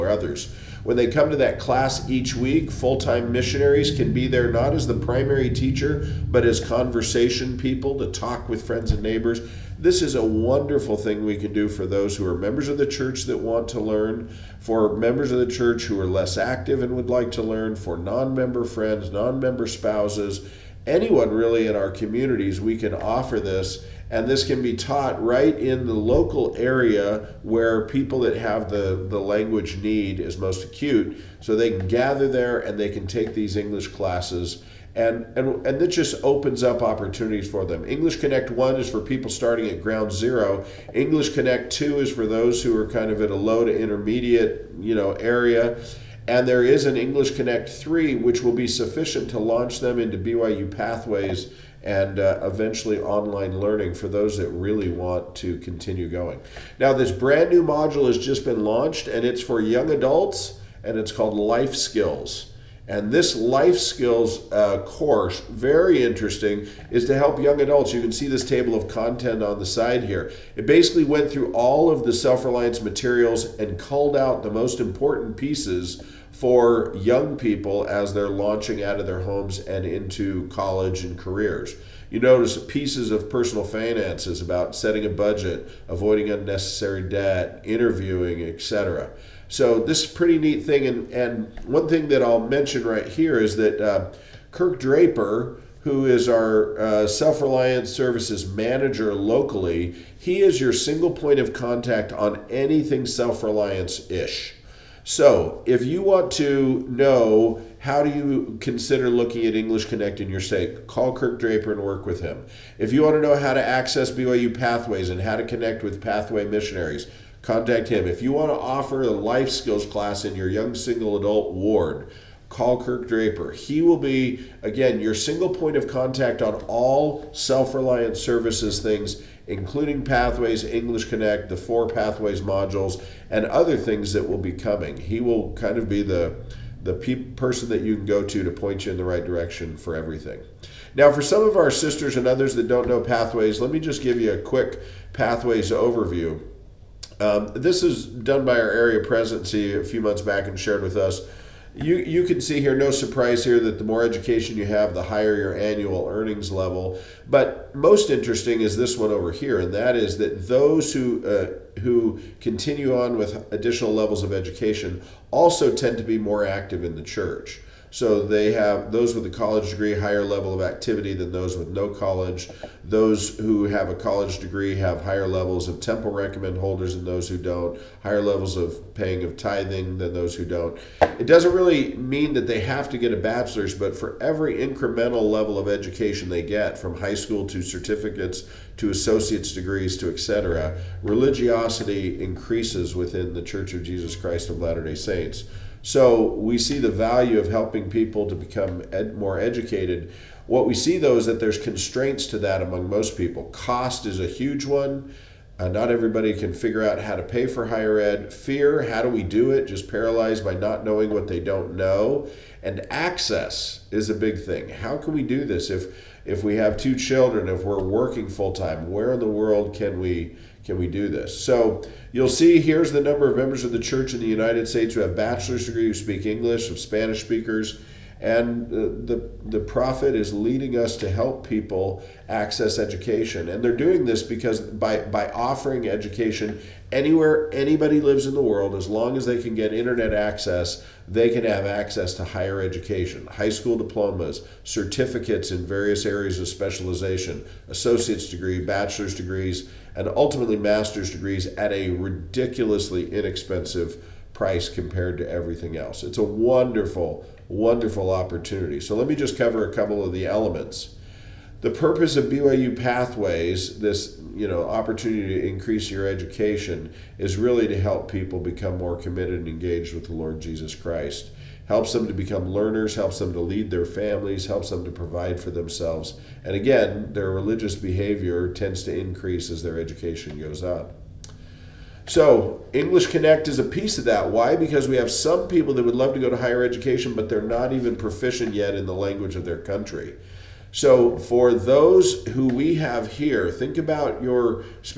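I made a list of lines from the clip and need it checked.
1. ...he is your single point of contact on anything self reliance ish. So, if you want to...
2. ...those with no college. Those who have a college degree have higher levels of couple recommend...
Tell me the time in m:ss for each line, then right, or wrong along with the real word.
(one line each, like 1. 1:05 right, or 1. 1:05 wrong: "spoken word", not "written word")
1. 1:40 right
2. 2:51 wrong: "temple", not "couple".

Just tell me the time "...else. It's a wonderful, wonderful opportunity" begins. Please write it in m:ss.
4:15.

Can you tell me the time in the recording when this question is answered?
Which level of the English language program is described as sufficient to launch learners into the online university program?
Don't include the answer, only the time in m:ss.
0:46.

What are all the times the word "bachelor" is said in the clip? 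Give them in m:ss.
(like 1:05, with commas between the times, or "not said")
3:03, 3:45, 4:08.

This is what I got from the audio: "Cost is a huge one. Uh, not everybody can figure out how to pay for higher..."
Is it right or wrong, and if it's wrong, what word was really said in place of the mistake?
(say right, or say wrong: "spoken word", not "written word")
right.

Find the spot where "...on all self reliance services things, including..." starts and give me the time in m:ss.
2:06.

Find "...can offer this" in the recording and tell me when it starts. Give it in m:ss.
0:22.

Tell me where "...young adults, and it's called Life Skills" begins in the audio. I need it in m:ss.
0:59.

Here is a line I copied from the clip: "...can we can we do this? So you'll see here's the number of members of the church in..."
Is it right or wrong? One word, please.
right.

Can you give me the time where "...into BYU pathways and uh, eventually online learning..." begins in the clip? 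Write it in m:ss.
0:49.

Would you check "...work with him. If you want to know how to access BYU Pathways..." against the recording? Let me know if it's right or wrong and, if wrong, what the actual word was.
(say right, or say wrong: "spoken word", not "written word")
right.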